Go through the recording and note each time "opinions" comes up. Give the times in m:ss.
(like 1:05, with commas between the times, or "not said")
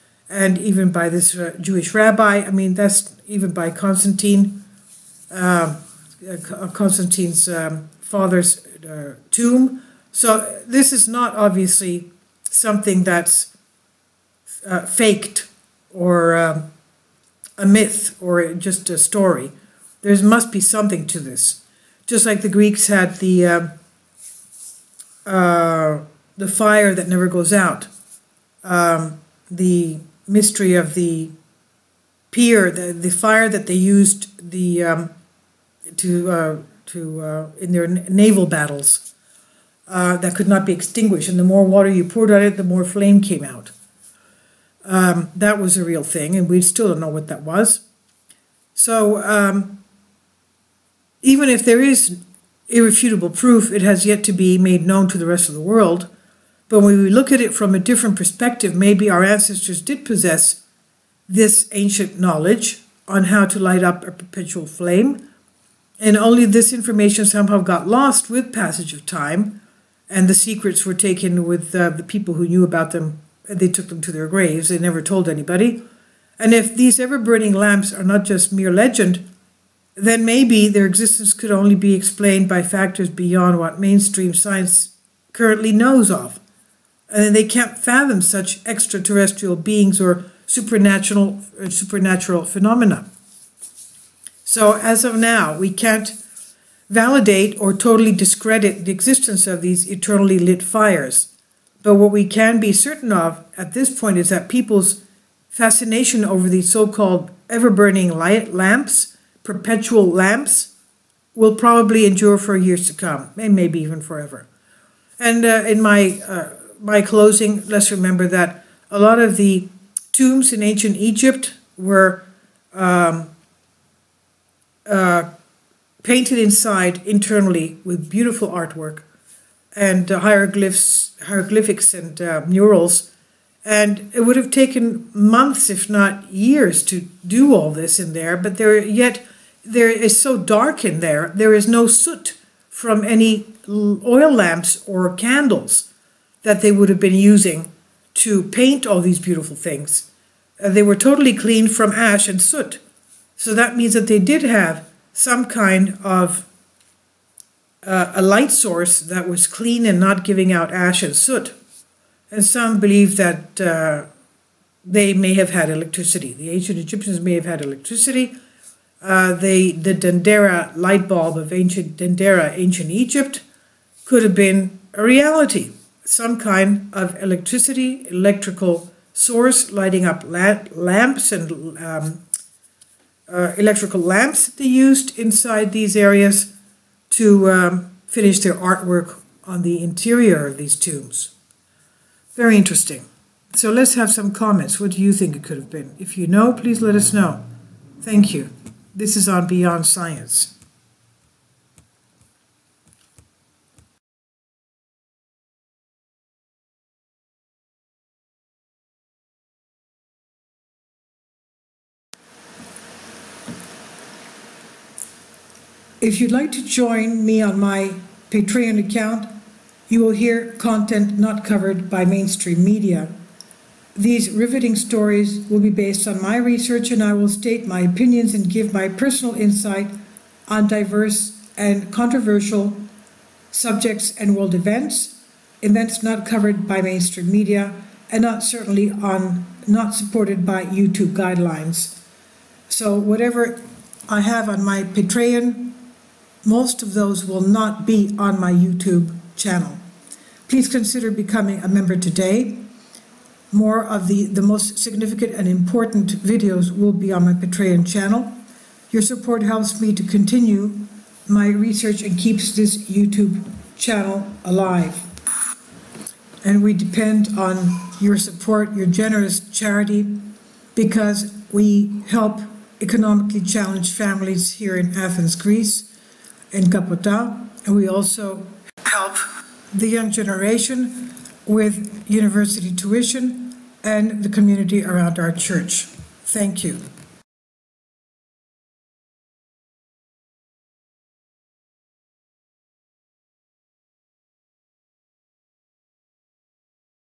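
3:47.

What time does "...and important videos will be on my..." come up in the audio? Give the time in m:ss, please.
4:15.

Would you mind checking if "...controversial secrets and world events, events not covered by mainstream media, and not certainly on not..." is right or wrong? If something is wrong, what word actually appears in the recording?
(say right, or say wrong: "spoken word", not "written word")
wrong: "subjects", not "secrets".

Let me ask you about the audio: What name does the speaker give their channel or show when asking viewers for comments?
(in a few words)
Beyond Science.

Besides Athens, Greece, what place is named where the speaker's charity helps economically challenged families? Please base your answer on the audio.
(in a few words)
Kapota.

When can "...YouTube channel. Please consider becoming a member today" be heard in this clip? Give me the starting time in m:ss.
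4:08.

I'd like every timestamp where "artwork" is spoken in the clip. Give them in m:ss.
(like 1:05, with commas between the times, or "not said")
2:08, 3:08.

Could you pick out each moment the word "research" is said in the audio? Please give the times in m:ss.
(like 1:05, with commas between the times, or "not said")
3:46, 4:21.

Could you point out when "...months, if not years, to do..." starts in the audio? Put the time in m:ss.
2:15.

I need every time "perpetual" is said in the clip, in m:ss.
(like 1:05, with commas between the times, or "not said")
1:04, 1:49.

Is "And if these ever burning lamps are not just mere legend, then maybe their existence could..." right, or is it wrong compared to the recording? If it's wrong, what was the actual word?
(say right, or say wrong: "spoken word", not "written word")
right.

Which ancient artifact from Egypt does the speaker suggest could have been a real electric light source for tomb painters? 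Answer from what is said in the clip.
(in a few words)
Dendera light bulb.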